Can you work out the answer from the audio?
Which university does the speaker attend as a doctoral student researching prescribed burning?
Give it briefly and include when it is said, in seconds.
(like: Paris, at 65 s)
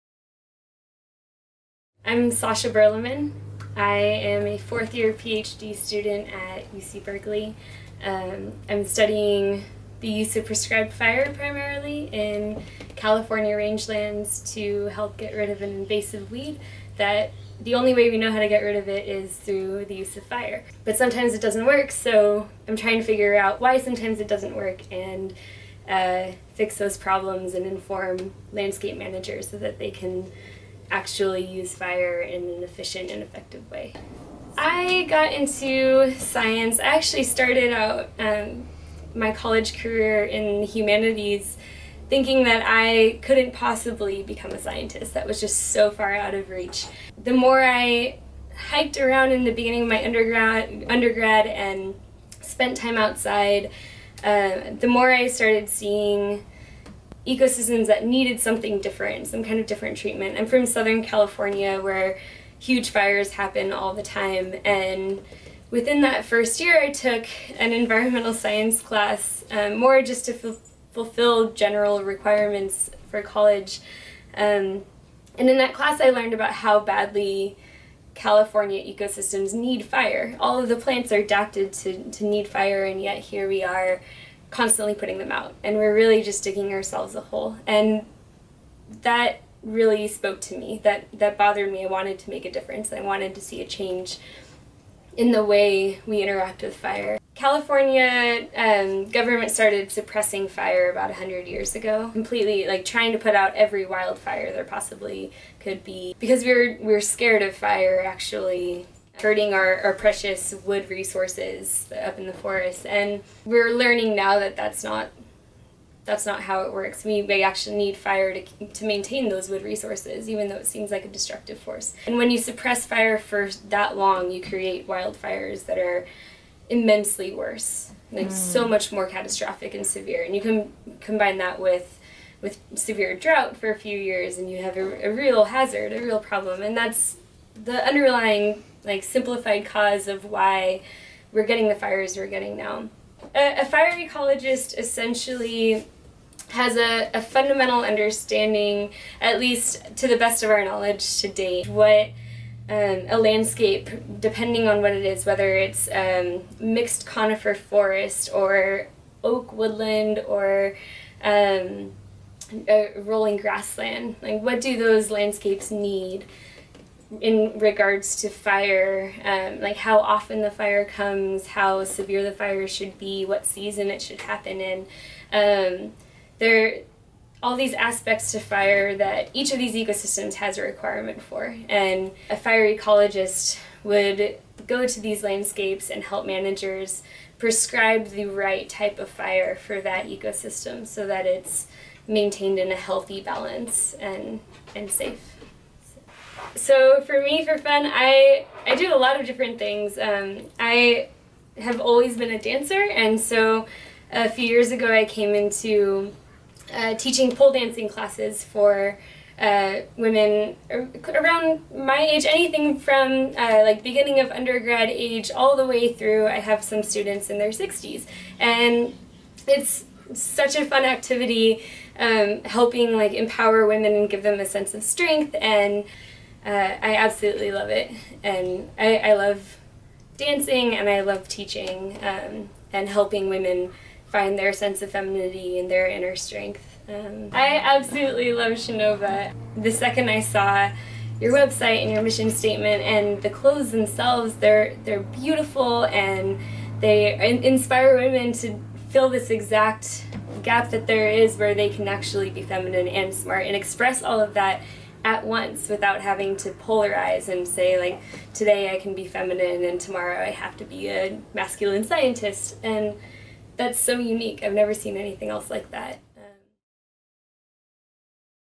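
UC Berkeley, at 6 s.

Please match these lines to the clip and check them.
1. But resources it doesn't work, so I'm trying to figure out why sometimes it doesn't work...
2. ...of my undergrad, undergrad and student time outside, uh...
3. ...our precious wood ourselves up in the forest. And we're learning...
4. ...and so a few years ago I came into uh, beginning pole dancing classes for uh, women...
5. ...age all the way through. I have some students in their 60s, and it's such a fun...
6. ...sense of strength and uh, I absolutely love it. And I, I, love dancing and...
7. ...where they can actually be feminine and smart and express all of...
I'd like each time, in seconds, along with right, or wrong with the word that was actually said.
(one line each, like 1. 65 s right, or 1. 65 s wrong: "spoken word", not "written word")
1. 20 s wrong: "sometimes", not "resources"
2. 49 s wrong: "spent", not "student"
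3. 109 s wrong: "resources", not "ourselves"
4. 202 s wrong: "teaching", not "beginning"
5. 214 s right
6. 224 s right
7. 251 s right.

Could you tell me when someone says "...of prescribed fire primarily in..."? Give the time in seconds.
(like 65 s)
10 s.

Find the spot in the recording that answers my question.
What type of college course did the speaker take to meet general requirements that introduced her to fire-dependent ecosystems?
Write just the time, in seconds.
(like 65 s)
67 s.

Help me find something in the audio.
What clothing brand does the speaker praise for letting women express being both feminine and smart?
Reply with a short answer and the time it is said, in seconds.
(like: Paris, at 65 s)
Shenova, at 238 s.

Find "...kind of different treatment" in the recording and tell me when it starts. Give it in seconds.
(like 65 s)
59 s.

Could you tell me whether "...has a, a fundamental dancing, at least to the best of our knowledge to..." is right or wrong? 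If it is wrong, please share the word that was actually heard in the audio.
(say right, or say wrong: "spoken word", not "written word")
wrong: "understanding", not "dancing".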